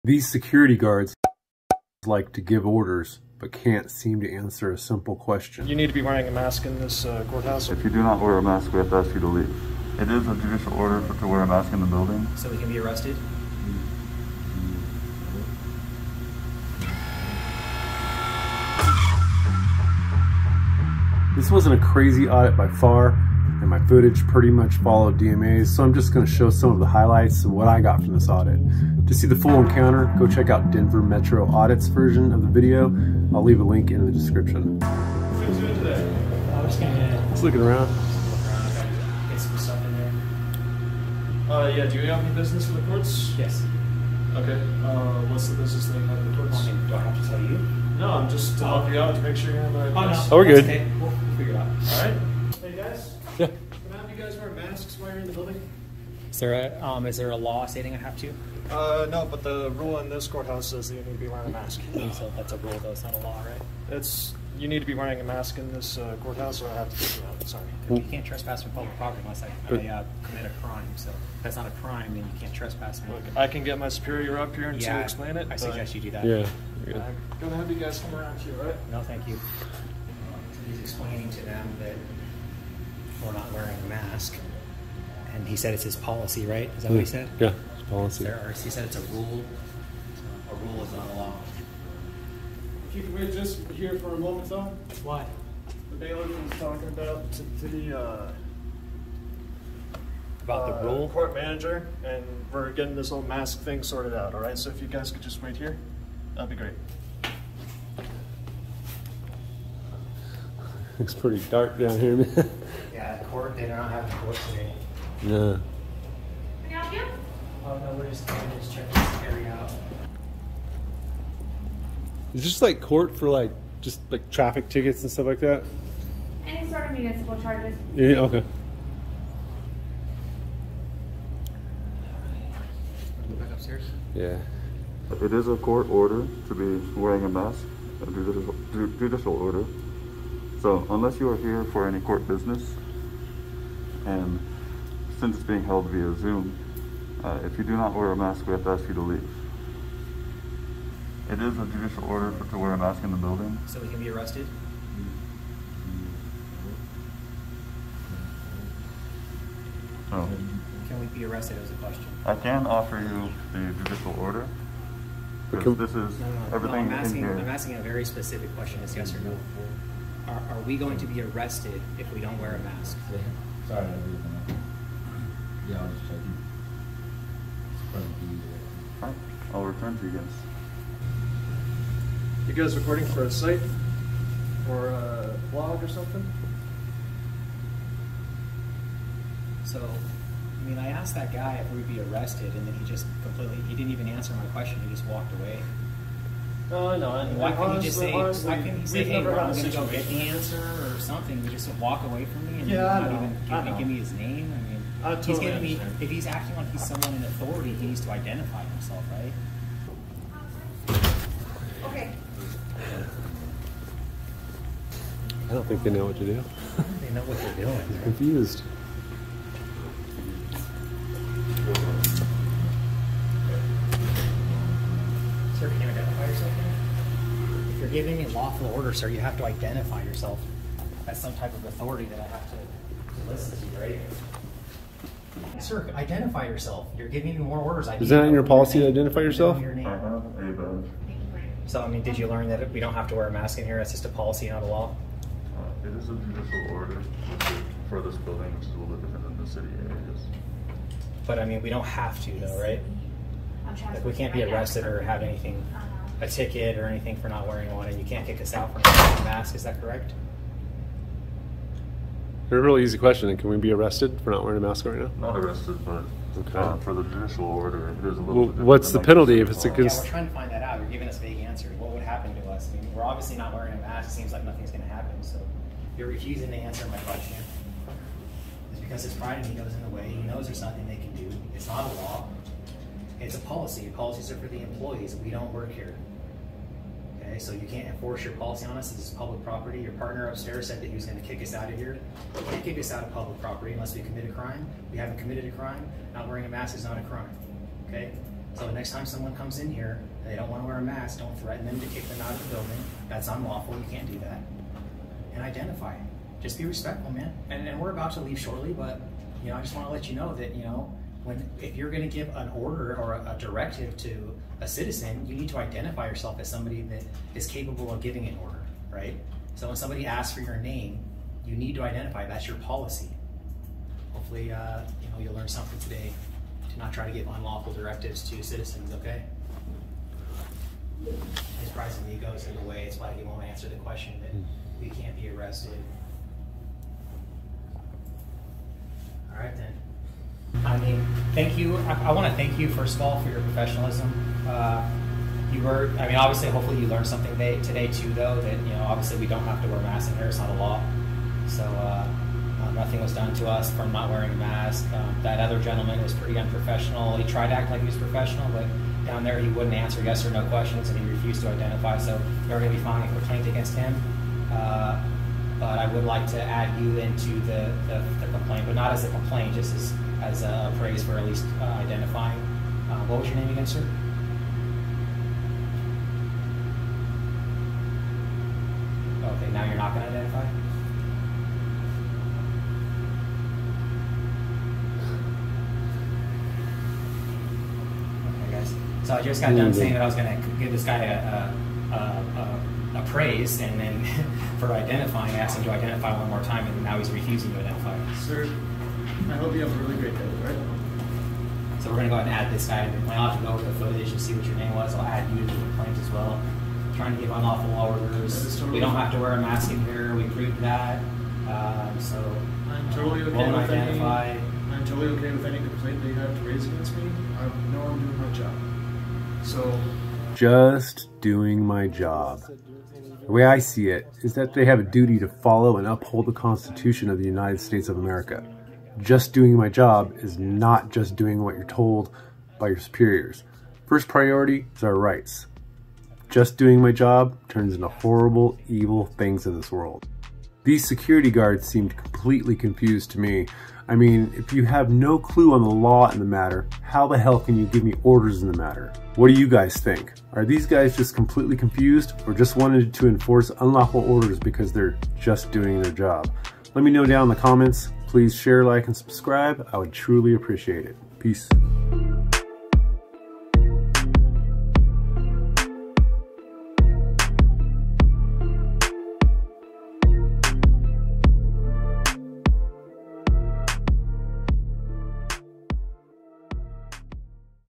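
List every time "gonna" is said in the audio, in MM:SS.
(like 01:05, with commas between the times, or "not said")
01:16, 06:41.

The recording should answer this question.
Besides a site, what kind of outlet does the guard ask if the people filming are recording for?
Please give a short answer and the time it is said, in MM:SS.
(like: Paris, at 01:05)
A blog, at 03:05.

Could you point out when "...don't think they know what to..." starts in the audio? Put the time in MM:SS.
03:35.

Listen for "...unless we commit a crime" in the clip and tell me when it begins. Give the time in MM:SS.
04:53.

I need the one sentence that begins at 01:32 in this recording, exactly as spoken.
Can we just here for a moment, though?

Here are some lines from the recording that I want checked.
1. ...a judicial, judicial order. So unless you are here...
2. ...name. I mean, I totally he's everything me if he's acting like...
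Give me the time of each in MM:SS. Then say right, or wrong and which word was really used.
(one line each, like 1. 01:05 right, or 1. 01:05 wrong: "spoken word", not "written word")
1. 02:18 right
2. 03:24 wrong: "giving", not "everything".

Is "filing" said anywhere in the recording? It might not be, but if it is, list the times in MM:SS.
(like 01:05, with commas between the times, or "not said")
06:02.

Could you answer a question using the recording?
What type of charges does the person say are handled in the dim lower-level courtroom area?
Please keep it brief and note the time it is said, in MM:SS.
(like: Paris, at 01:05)
Municipal charges, at 02:06.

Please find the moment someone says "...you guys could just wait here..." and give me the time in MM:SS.
01:44.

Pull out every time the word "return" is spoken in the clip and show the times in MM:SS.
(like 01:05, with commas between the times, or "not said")
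02:59.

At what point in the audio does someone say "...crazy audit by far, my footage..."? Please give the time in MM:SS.
00:21.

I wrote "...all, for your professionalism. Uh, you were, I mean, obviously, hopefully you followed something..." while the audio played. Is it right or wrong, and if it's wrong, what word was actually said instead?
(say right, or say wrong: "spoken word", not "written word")
wrong: "learned", not "followed".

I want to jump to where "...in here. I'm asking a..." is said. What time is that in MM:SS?
02:47.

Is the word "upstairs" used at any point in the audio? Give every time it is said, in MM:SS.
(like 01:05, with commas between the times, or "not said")
02:13, 04:50.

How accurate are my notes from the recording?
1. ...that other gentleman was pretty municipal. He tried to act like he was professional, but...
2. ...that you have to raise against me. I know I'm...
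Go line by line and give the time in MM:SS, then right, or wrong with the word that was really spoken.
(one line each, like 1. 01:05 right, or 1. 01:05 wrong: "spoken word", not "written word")
1. 05:55 wrong: "unprofessional", not "municipal"
2. 06:56 right.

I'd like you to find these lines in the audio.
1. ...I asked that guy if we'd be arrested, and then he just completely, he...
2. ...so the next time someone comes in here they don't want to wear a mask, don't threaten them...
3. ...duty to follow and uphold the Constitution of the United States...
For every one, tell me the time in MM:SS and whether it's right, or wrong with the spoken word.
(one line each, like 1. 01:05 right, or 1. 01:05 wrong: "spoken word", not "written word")
1. 03:10 right
2. 04:58 right
3. 07:04 right.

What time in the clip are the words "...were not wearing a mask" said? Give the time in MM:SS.
01:23.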